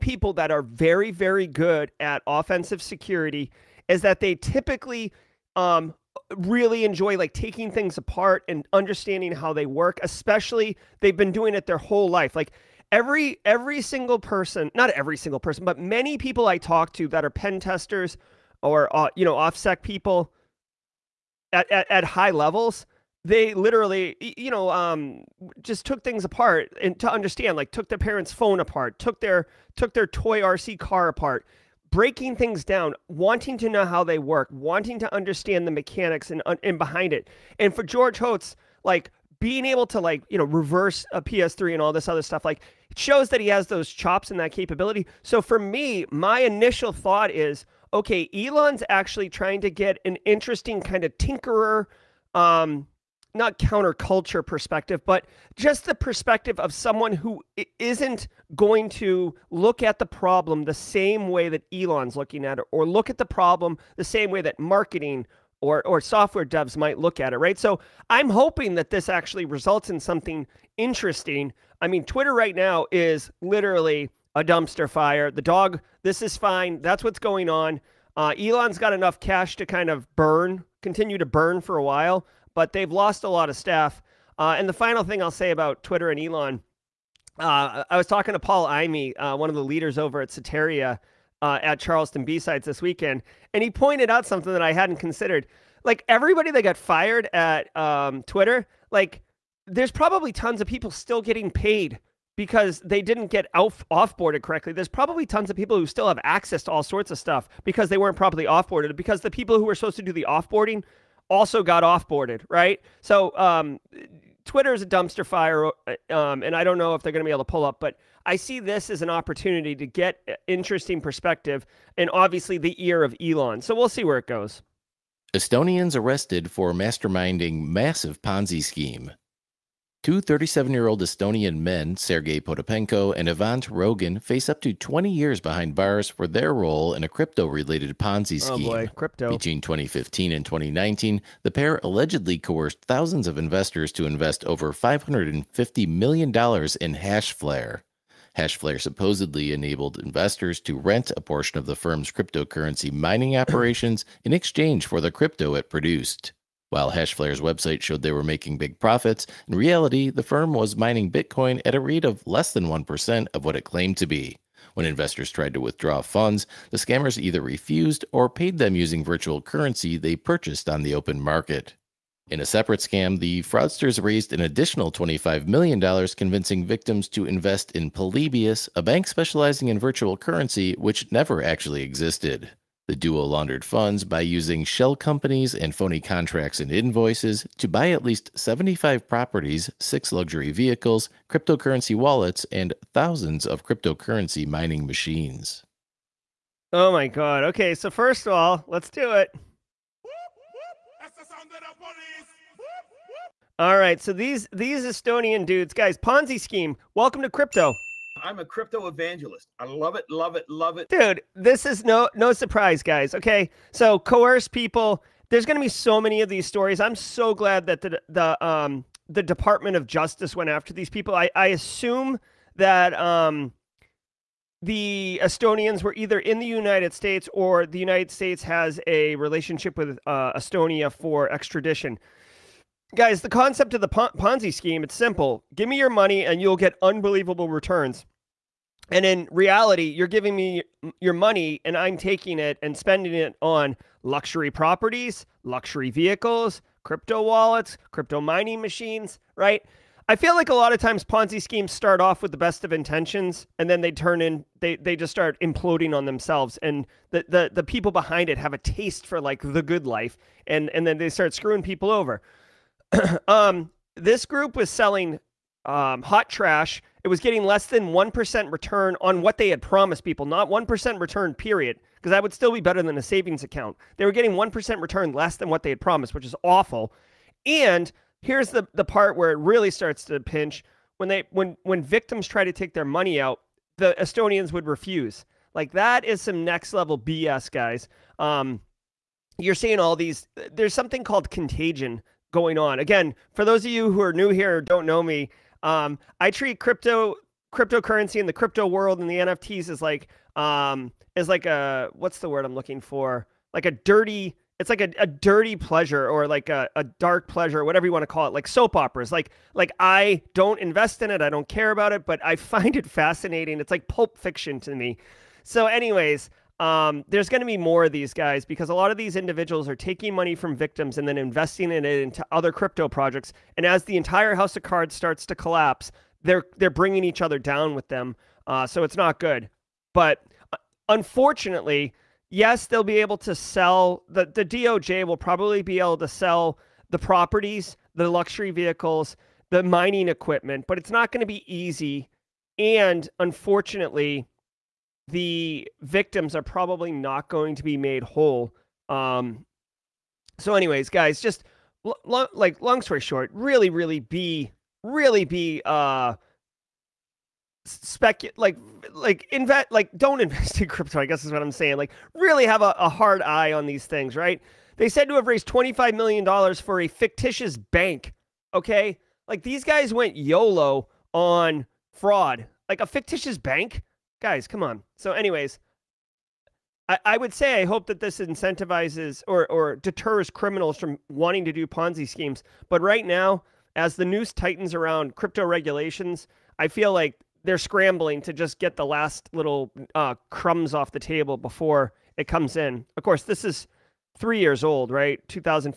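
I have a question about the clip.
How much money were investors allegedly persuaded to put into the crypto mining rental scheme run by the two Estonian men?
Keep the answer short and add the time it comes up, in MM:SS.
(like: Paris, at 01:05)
$550 million, at 02:24.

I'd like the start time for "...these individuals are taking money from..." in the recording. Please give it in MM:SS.
05:18.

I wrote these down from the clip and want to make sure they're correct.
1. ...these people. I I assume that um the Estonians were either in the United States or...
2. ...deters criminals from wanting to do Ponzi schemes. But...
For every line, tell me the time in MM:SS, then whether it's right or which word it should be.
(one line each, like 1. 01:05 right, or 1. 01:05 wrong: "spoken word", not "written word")
1. 03:40 right
2. 06:19 right.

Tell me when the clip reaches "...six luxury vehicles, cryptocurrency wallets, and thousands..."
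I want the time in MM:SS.
03:09.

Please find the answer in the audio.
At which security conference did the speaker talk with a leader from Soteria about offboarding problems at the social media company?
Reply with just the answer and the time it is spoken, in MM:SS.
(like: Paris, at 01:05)
Charleston B-Sides, at 01:31.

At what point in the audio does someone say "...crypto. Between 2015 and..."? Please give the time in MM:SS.
02:18.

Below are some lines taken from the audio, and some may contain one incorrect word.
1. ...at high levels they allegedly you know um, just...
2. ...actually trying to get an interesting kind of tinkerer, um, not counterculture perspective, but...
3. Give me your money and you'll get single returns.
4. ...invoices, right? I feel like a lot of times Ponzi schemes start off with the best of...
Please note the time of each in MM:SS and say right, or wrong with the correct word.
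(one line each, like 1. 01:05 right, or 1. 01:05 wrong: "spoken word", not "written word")
1. 00:21 wrong: "literally", not "allegedly"
2. 00:48 right
3. 03:55 wrong: "unbelievable", not "single"
4. 04:08 wrong: "machines", not "invoices".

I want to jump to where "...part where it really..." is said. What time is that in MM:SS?
04:38.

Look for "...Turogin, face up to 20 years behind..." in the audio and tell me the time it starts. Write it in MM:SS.
02:13.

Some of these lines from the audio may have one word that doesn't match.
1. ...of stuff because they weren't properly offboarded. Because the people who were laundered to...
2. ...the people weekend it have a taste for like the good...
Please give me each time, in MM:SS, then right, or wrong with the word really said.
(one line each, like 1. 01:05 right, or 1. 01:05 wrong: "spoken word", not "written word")
1. 01:47 wrong: "supposed", not "laundered"
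2. 04:17 wrong: "behind", not "weekend".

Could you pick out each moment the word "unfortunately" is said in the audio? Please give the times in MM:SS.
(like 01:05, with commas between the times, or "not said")
05:30, 05:43.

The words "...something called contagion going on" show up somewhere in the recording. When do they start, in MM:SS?
04:50.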